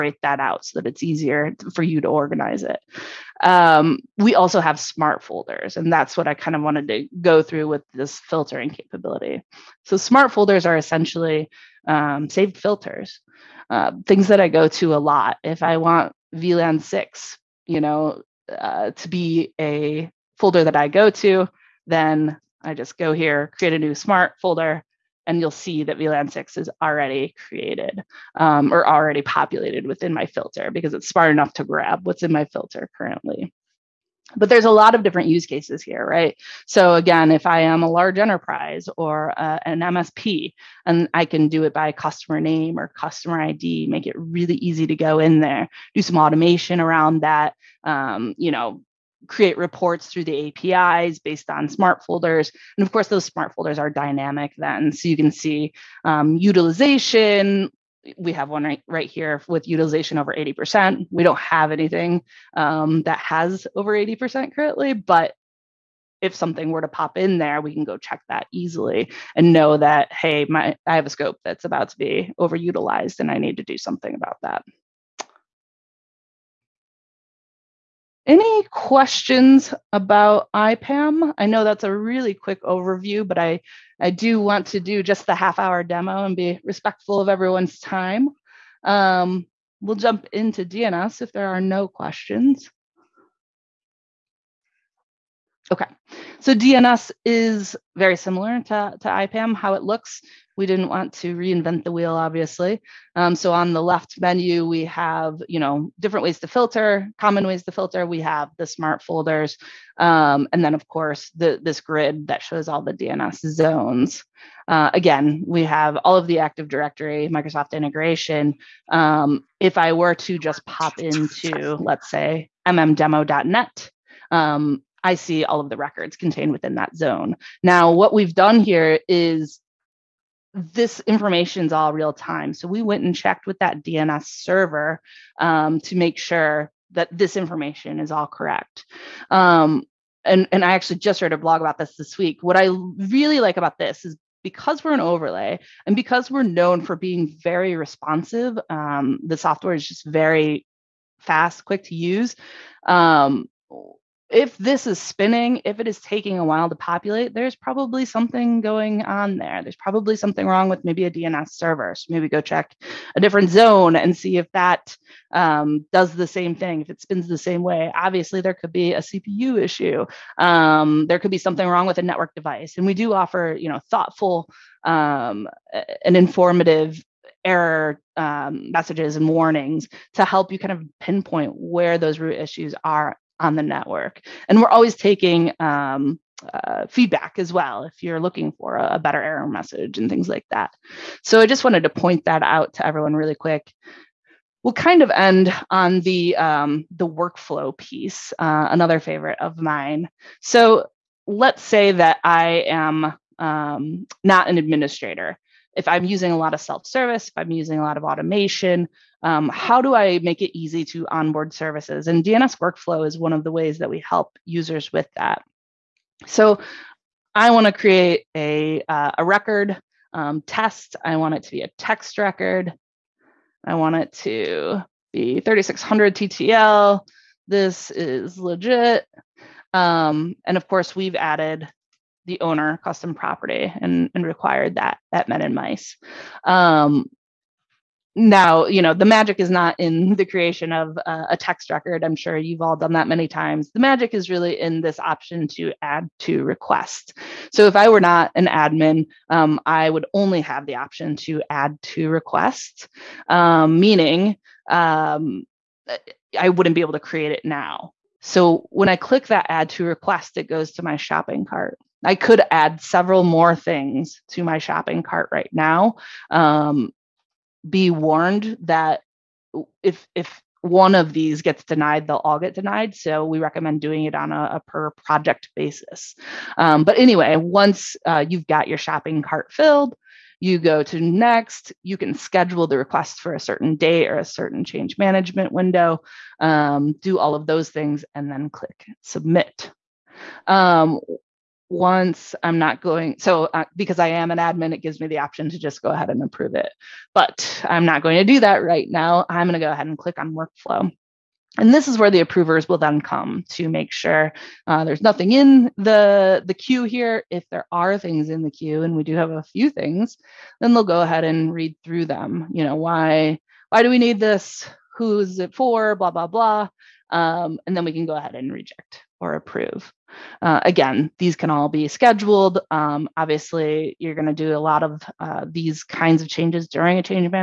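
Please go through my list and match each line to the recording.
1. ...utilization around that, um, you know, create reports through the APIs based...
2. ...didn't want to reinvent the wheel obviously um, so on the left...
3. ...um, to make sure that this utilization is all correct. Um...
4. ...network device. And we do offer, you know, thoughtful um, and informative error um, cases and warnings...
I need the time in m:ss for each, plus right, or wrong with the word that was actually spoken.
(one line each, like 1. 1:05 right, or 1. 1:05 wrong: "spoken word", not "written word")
1. 0:46 wrong: "automation", not "utilization"
2. 1:40 right
3. 2:15 wrong: "information", not "utilization"
4. 2:52 wrong: "messages", not "cases".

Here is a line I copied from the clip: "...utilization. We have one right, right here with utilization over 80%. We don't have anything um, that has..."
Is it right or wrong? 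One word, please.
right.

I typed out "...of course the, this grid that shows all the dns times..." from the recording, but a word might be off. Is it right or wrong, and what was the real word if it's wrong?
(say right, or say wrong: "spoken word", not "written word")
wrong: "zones", not "times".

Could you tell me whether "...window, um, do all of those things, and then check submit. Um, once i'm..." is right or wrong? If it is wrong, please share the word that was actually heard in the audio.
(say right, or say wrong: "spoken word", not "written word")
wrong: "click", not "check".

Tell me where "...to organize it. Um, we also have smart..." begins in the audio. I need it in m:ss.
0:02.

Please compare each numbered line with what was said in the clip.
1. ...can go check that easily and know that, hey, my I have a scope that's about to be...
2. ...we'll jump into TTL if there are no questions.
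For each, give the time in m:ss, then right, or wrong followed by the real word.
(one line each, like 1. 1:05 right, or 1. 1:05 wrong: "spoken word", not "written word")
1. 1:07 right
2. 1:29 wrong: "DNS", not "TTL".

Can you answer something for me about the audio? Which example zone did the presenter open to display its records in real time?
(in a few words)
mmdemo.net.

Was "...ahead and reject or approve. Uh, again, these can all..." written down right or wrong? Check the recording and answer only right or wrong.
right.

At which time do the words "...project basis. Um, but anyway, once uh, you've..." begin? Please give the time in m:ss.
4:34.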